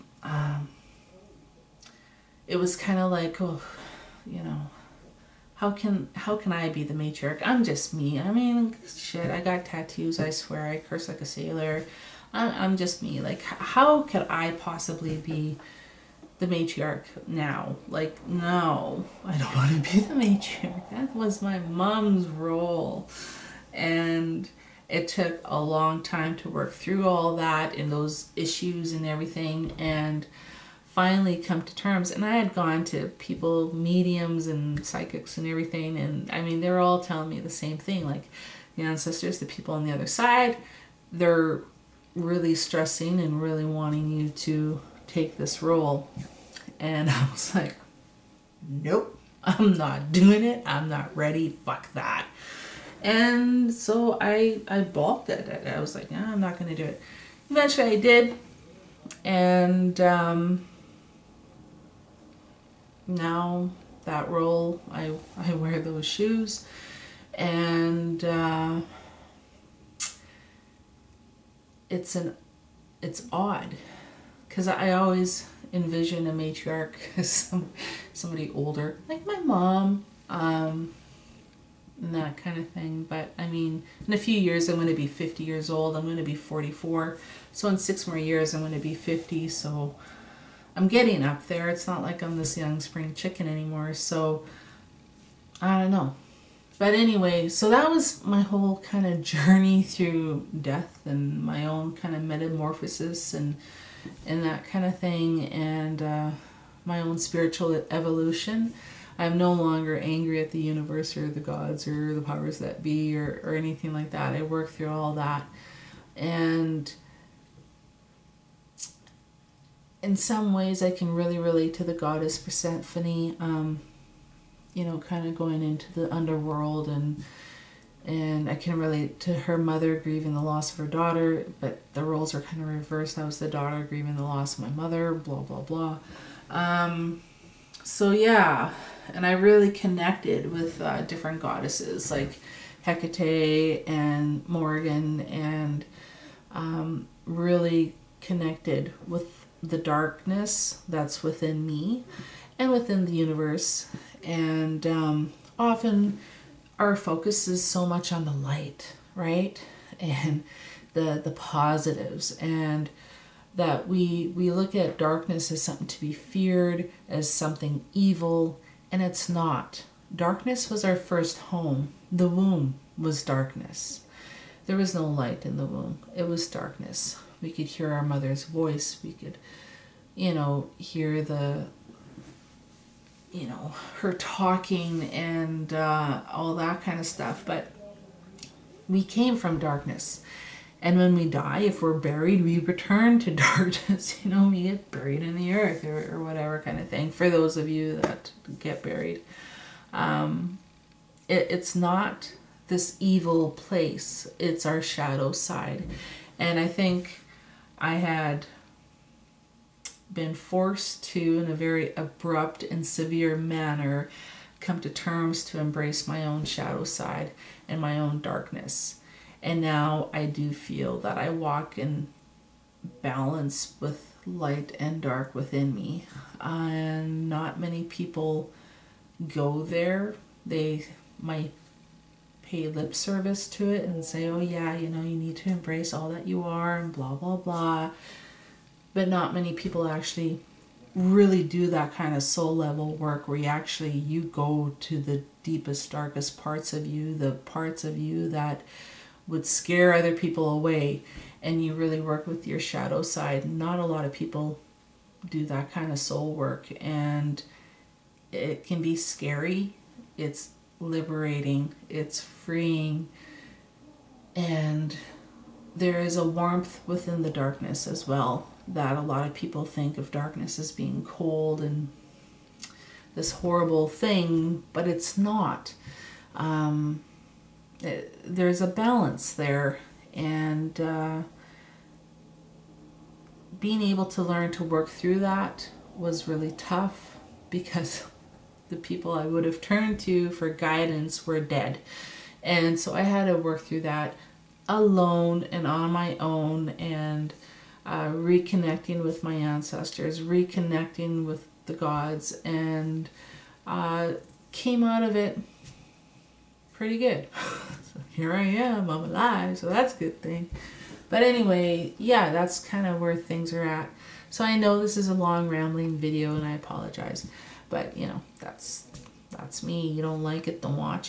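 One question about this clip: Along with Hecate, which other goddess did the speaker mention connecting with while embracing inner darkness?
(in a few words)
Morrigan.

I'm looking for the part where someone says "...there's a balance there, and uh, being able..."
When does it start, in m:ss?
4:38.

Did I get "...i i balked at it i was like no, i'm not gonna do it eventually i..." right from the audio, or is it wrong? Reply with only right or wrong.
right.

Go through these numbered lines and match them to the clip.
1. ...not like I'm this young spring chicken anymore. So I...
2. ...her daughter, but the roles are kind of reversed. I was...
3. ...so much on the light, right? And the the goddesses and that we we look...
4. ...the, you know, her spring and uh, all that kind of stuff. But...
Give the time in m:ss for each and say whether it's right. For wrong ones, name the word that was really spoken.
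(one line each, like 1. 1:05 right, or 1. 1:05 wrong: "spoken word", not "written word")
1. 1:31 right
2. 2:10 right
3. 2:37 wrong: "positives", not "goddesses"
4. 3:01 wrong: "talking", not "spring".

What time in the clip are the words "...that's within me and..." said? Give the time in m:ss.
2:30.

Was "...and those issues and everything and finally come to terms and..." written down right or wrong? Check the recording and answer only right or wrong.
right.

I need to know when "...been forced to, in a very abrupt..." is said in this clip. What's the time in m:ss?
3:30.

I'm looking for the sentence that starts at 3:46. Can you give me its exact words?
And uh, not many people go there.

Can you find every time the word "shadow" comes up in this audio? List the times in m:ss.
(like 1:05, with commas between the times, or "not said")
3:24, 3:36, 4:12.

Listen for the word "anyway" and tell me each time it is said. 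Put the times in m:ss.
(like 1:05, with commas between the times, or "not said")
1:36, 5:11.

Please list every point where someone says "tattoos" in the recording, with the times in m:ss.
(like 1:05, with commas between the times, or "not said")
0:09.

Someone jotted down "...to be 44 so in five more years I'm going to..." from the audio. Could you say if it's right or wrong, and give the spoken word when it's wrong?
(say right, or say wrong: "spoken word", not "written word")
wrong: "six", not "five".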